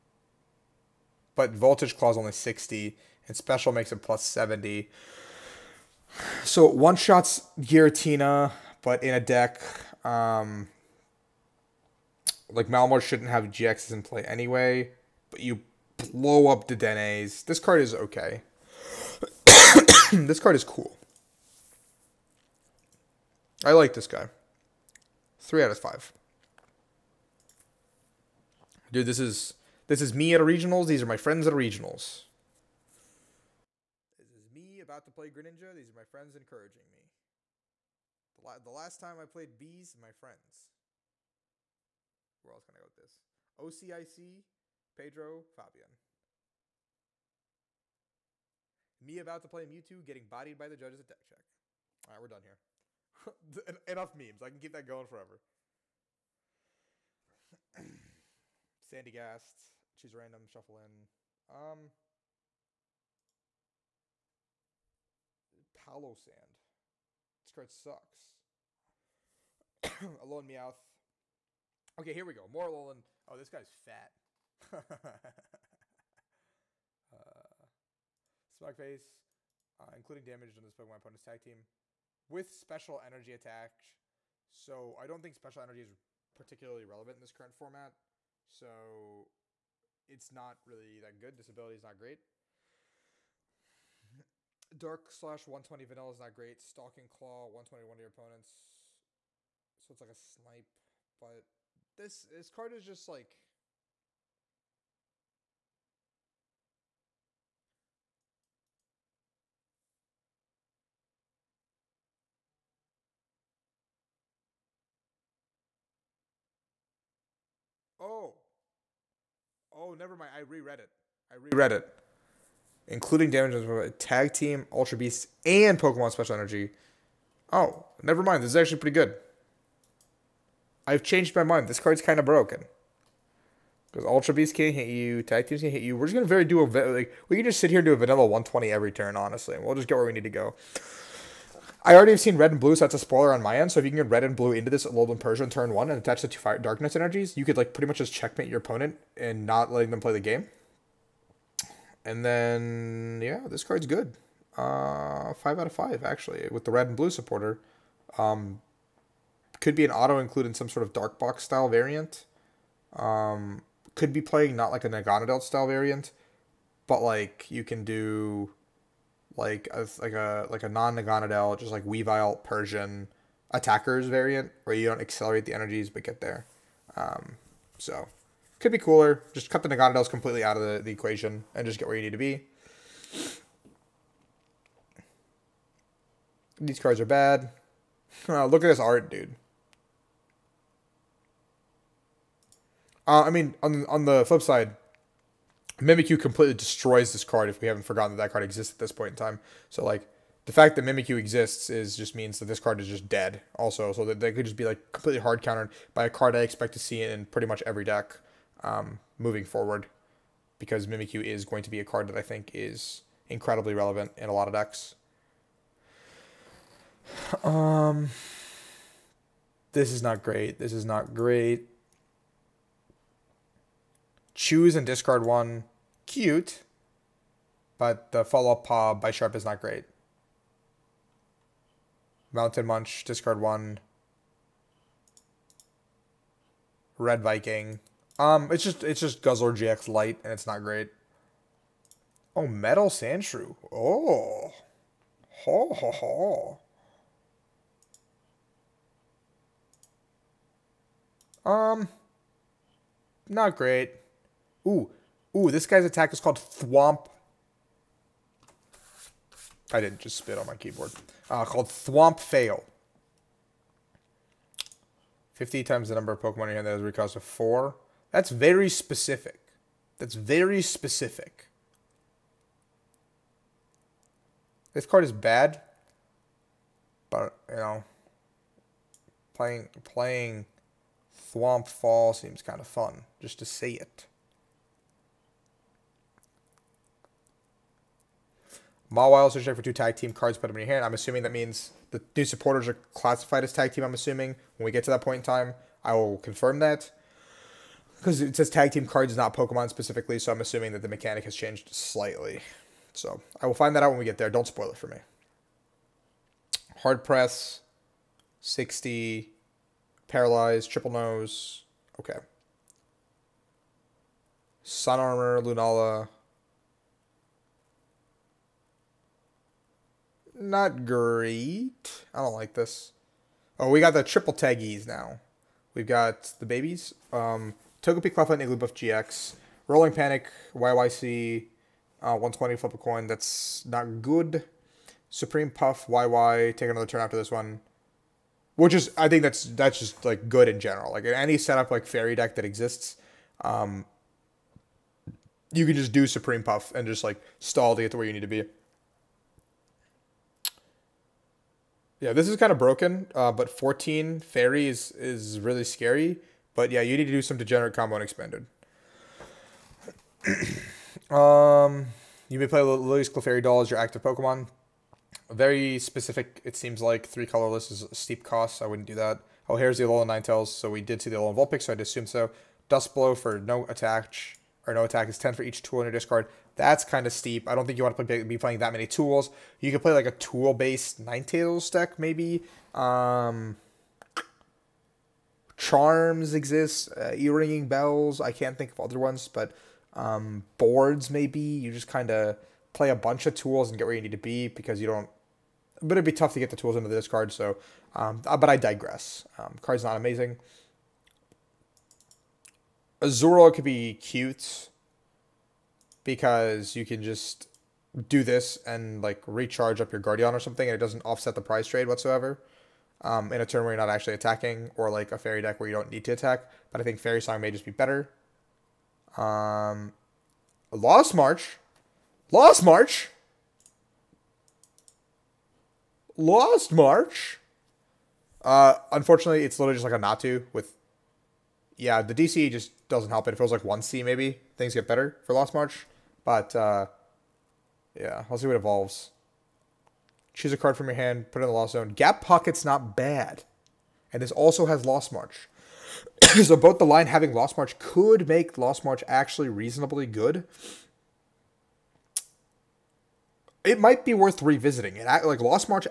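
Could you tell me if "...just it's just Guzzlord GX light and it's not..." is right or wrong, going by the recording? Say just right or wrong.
right.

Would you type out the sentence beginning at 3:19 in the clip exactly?
So, like, the fact that Mimikyu exists is just means that this card is just dead also.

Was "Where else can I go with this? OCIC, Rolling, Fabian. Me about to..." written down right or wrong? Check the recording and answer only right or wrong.
wrong.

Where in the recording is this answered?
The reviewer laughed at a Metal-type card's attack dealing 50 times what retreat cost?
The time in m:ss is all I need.
4:27.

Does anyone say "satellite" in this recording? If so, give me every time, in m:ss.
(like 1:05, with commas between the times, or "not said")
not said.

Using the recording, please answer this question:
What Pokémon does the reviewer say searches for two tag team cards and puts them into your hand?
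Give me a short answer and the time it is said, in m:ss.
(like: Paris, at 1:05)
Mawile, at 4:48.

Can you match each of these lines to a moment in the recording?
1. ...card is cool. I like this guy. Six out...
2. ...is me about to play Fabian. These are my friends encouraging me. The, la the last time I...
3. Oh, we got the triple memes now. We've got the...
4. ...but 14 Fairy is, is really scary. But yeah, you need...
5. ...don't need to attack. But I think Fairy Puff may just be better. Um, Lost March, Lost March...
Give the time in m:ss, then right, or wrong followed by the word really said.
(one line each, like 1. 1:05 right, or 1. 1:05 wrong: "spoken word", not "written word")
1. 0:20 wrong: "Three", not "Six"
2. 0:34 wrong: "Greninja", not "Fabian"
3. 5:23 wrong: "taggies", not "memes"
4. 5:53 right
5. 6:55 wrong: "Song", not "Puff".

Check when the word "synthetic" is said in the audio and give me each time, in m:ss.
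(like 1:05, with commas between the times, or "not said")
not said.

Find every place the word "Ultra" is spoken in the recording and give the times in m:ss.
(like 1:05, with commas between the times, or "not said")
2:04, 2:14.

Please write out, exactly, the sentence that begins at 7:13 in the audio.
If it was like 1C, maybe things get better for Lost March.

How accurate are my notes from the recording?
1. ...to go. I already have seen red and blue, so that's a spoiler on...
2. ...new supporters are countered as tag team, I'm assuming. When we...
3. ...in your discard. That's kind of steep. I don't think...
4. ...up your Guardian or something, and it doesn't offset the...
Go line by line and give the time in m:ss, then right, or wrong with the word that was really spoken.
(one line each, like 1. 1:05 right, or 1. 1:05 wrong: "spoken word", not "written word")
1. 2:20 right
2. 4:52 wrong: "classified", not "countered"
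3. 6:15 right
4. 6:49 right.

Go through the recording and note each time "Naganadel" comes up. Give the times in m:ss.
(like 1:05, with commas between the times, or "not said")
2:44, 2:50, 2:59.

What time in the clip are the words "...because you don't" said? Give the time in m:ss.
6:34.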